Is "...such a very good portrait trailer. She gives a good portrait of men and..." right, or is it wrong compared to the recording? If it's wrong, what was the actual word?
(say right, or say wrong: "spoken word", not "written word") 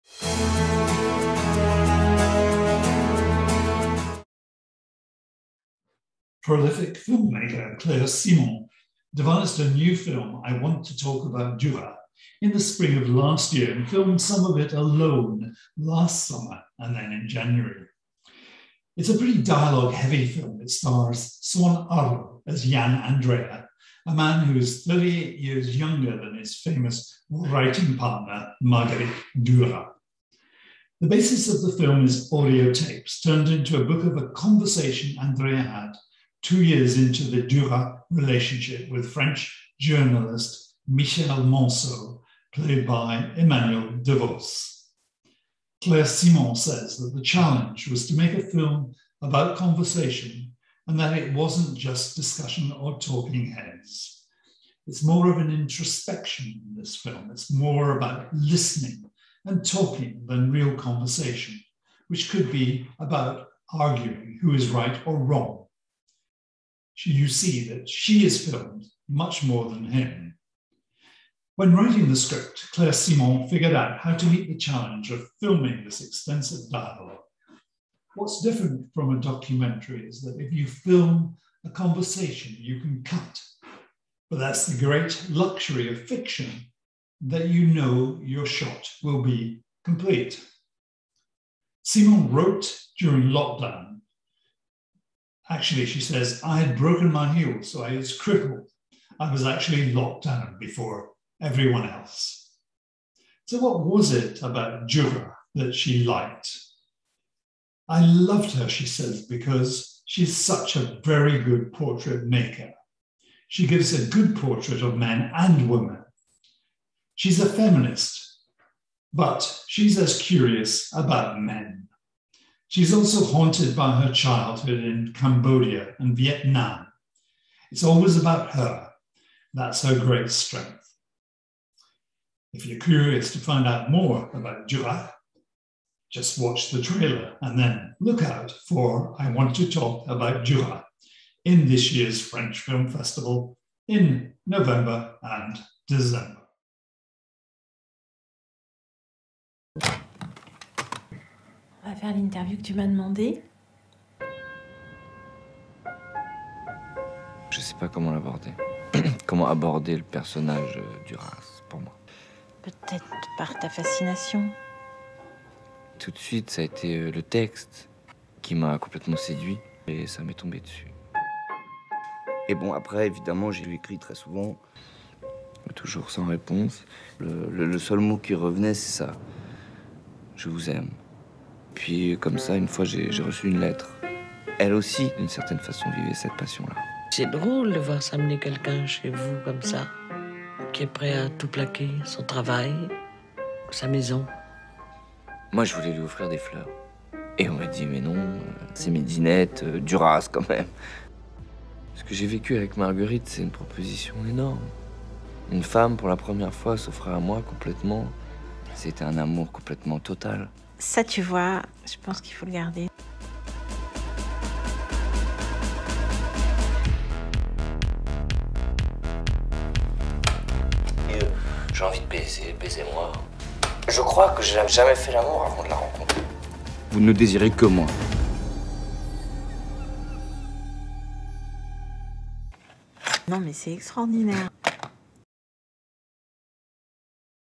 wrong: "maker", not "trailer".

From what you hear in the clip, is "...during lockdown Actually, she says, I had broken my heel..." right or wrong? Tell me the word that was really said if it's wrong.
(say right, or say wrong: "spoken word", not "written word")
right.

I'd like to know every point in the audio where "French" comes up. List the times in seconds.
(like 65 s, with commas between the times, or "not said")
39 s, 142 s.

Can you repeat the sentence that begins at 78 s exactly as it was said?
What's different from a documentary is that if you film a conversation, you can cut.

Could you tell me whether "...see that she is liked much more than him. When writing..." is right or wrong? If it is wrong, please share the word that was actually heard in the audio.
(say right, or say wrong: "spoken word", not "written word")
wrong: "filmed", not "liked".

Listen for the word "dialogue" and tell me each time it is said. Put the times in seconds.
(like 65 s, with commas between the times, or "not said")
19 s, 76 s.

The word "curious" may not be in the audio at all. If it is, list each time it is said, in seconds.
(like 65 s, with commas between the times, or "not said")
120 s, 132 s.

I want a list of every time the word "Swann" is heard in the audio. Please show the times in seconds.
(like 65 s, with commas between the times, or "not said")
21 s.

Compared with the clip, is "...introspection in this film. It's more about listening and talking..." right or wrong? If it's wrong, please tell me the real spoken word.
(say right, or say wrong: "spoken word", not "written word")
right.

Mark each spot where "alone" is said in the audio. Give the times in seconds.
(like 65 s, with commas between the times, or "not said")
14 s.